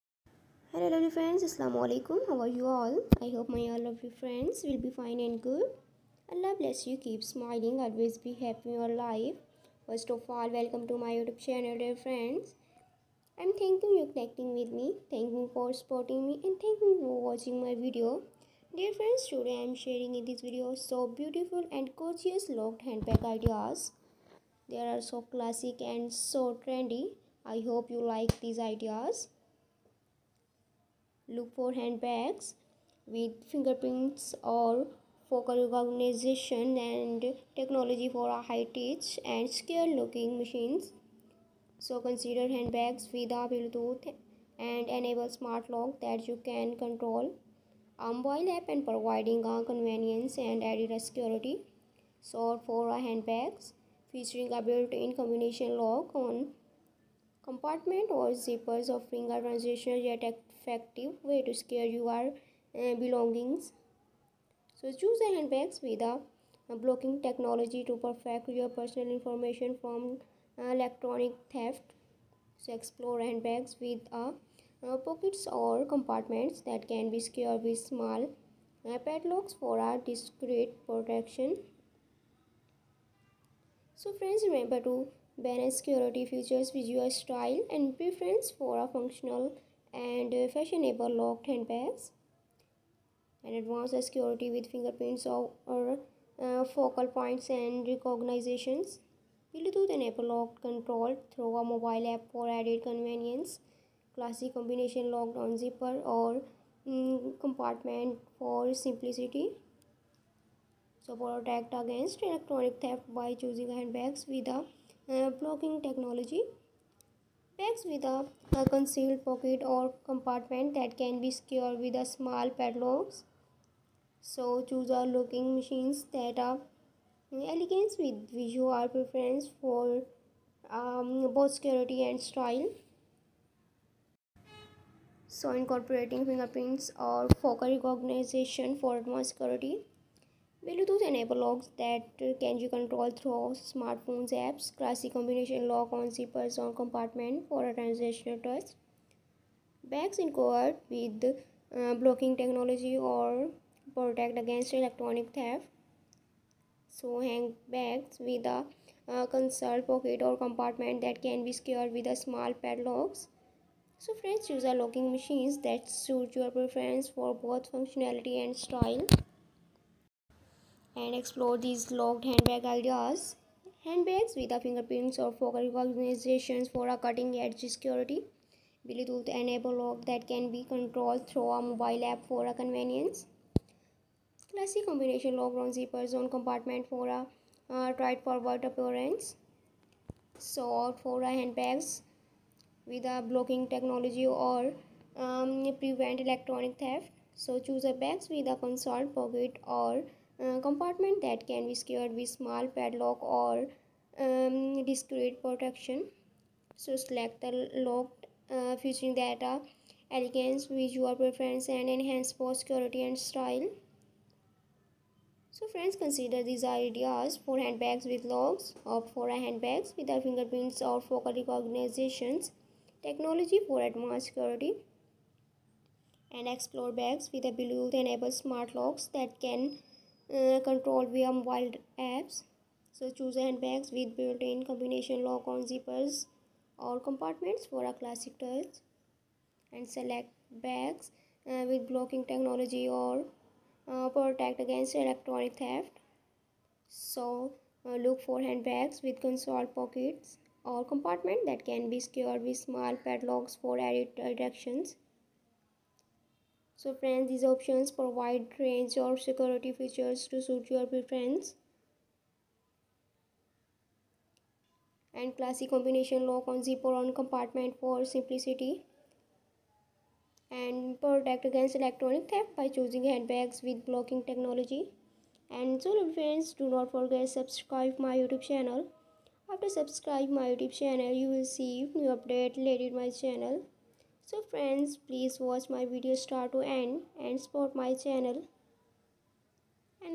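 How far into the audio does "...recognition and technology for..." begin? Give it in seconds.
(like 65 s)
35 s.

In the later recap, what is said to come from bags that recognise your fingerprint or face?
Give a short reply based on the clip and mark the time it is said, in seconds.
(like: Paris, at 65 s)
cutting-edge security, at 176 s.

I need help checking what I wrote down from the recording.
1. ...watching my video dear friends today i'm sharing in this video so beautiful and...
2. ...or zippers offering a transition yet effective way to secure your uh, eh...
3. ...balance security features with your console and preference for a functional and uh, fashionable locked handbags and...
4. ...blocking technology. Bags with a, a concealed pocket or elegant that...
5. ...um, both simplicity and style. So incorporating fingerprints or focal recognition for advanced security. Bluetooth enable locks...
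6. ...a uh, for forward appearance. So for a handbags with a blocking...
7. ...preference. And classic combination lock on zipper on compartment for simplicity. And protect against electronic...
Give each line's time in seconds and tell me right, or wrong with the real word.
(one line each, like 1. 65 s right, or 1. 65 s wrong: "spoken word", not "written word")
1. 17 s right
2. 58 s right
3. 85 s wrong: "style", not "console"
4. 115 s wrong: "compartment", not "elegant"
5. 130 s wrong: "security", not "simplicity"
6. 187 s right
7. 260 s right.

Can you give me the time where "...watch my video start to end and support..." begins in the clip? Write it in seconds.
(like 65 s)
285 s.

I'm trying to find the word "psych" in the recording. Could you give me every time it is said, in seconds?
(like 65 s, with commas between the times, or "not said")
not said.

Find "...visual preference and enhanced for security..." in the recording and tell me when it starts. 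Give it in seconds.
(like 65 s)
210 s.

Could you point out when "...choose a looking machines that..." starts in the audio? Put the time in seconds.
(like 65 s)
124 s.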